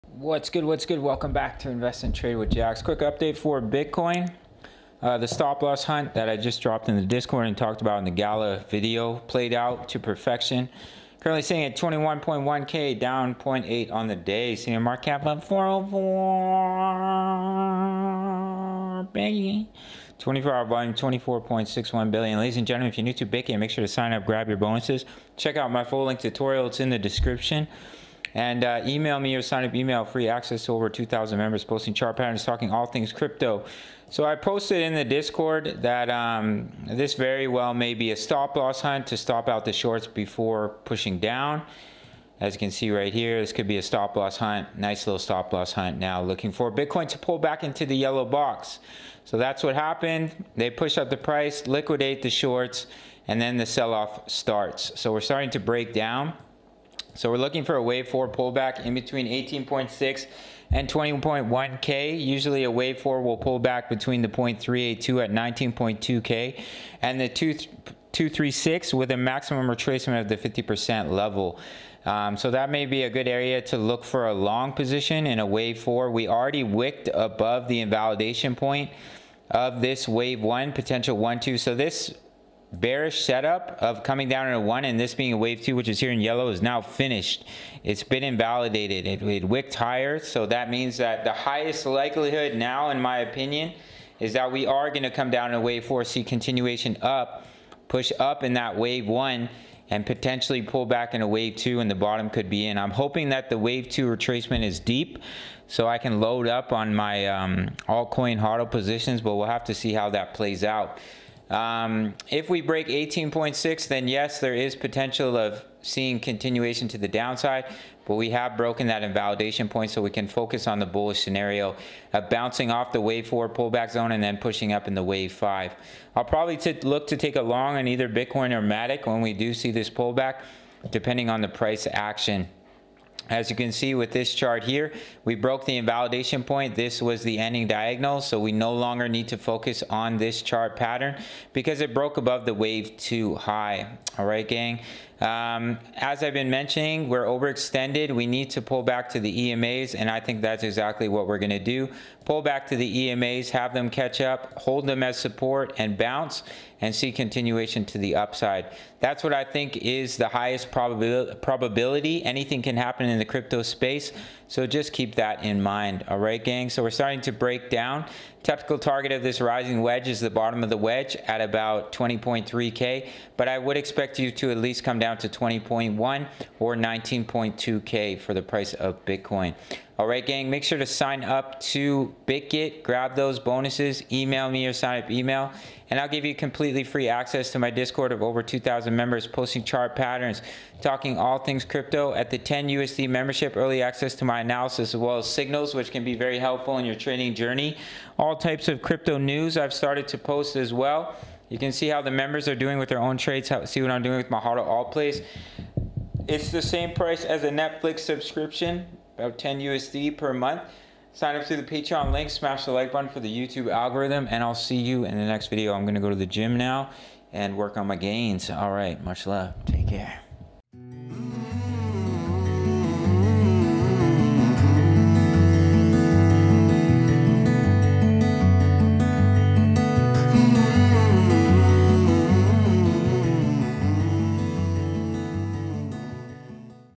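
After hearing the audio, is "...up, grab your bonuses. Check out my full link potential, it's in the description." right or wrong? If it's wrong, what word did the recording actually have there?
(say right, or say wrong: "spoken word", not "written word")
wrong: "tutorial", not "potential".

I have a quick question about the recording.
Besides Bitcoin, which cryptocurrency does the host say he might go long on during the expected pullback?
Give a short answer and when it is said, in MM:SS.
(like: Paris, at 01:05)
Matic, at 02:08.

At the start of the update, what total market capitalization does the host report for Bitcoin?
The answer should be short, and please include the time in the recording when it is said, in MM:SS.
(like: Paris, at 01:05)
404 billion, at 00:15.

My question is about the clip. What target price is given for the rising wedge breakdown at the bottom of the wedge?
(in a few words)
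20.3K.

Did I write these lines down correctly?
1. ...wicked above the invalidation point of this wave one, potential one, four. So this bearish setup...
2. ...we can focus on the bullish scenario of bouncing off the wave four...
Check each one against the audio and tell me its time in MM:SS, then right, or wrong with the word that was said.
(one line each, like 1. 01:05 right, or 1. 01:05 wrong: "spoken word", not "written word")
1. 01:16 wrong: "two", not "four"
2. 02:00 right.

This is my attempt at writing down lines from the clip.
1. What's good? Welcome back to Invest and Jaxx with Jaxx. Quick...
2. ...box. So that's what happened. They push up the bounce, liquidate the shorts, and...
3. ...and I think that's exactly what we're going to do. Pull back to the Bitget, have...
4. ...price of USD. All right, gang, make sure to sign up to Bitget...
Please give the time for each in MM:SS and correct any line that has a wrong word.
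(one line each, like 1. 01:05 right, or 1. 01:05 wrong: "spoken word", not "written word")
1. 00:00 wrong: "Trade", not "Jaxx"
2. 00:48 wrong: "price", not "bounce"
3. 02:29 wrong: "EMAs", not "Bitget"
4. 02:58 wrong: "Bitcoin", not "USD".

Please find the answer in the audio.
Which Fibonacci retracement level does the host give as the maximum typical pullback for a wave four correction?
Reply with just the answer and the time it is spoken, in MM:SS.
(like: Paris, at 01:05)
50%, at 01:10.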